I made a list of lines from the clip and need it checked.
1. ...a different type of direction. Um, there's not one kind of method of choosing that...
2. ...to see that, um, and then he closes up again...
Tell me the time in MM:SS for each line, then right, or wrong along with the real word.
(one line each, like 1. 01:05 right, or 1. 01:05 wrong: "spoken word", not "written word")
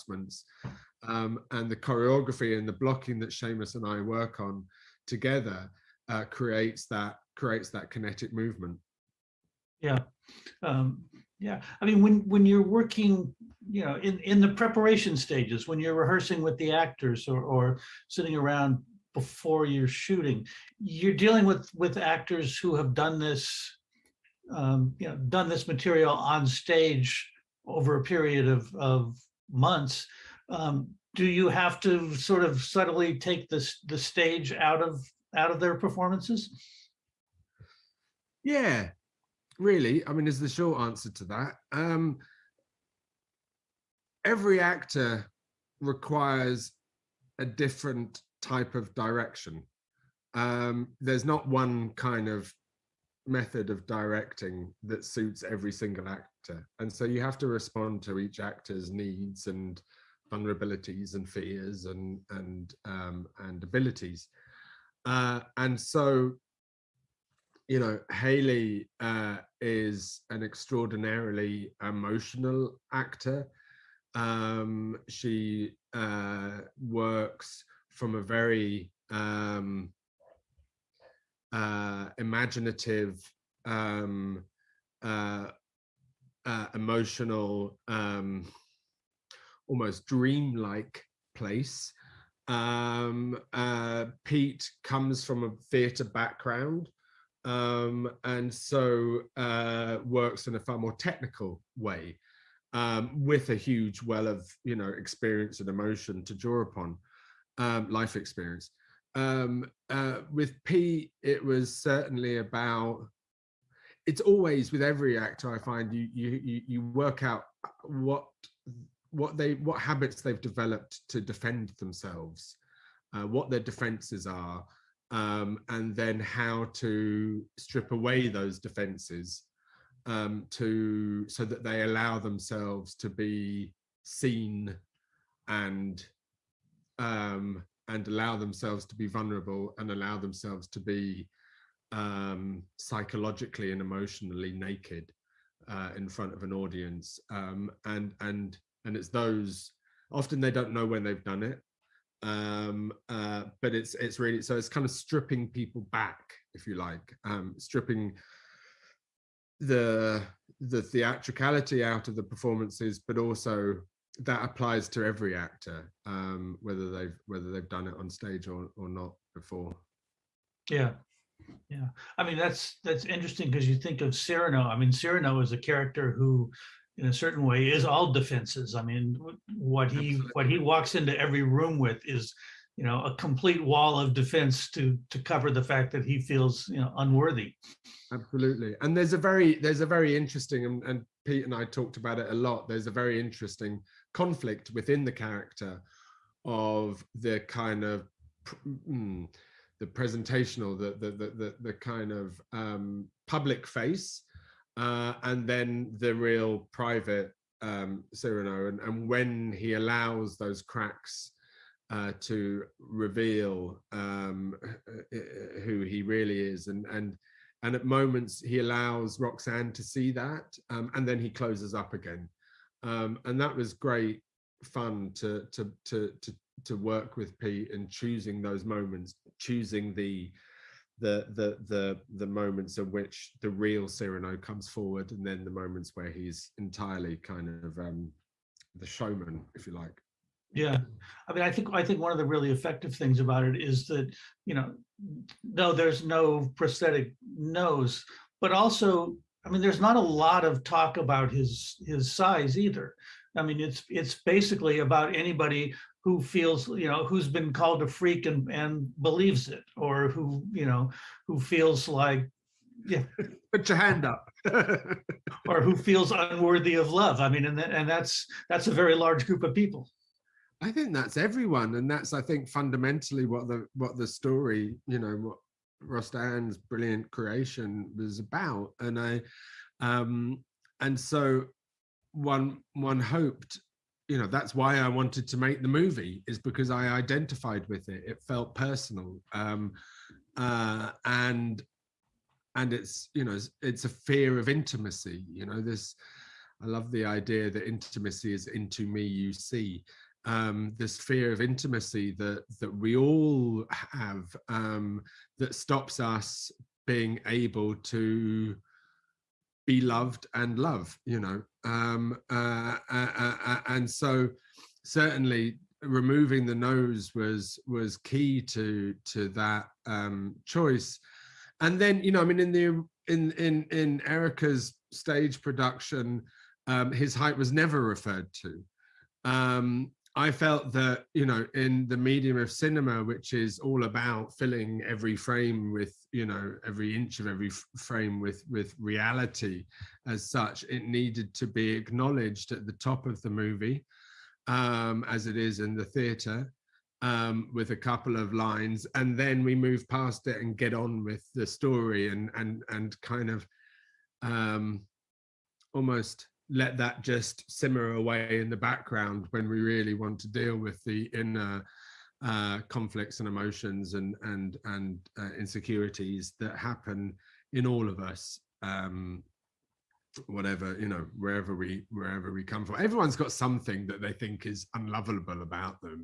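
1. 00:47 wrong: "directing", not "choosing"
2. 03:39 right.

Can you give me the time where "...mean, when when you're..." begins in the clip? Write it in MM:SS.
00:11.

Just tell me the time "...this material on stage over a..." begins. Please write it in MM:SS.
00:25.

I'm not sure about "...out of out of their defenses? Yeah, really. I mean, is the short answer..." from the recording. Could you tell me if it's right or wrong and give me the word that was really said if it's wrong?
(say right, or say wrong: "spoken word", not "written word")
wrong: "performances", not "defenses".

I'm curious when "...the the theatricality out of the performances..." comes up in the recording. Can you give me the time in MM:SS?
02:39.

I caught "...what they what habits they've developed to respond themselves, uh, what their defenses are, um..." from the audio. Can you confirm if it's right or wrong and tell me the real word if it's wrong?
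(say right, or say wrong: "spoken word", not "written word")
wrong: "defend", not "respond".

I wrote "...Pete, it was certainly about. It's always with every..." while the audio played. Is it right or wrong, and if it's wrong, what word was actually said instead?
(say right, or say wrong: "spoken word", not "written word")
right.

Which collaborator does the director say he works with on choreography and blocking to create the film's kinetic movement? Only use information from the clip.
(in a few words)
Seamus.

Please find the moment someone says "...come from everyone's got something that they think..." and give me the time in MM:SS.
06:12.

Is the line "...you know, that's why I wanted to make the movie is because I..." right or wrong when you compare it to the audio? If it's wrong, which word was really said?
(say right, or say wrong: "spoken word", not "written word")
right.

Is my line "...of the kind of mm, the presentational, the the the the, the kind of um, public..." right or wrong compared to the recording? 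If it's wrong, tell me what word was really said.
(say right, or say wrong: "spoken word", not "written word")
right.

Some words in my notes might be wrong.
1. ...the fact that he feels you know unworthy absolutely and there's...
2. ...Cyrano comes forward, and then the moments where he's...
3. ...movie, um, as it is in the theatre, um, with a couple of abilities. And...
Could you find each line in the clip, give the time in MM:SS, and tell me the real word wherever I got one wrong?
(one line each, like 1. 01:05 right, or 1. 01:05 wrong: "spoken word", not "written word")
1. 03:05 right
2. 03:53 right
3. 05:43 wrong: "lines", not "abilities".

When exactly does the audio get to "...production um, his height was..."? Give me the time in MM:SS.
05:25.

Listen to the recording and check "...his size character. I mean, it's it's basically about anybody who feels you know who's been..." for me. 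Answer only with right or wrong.
wrong.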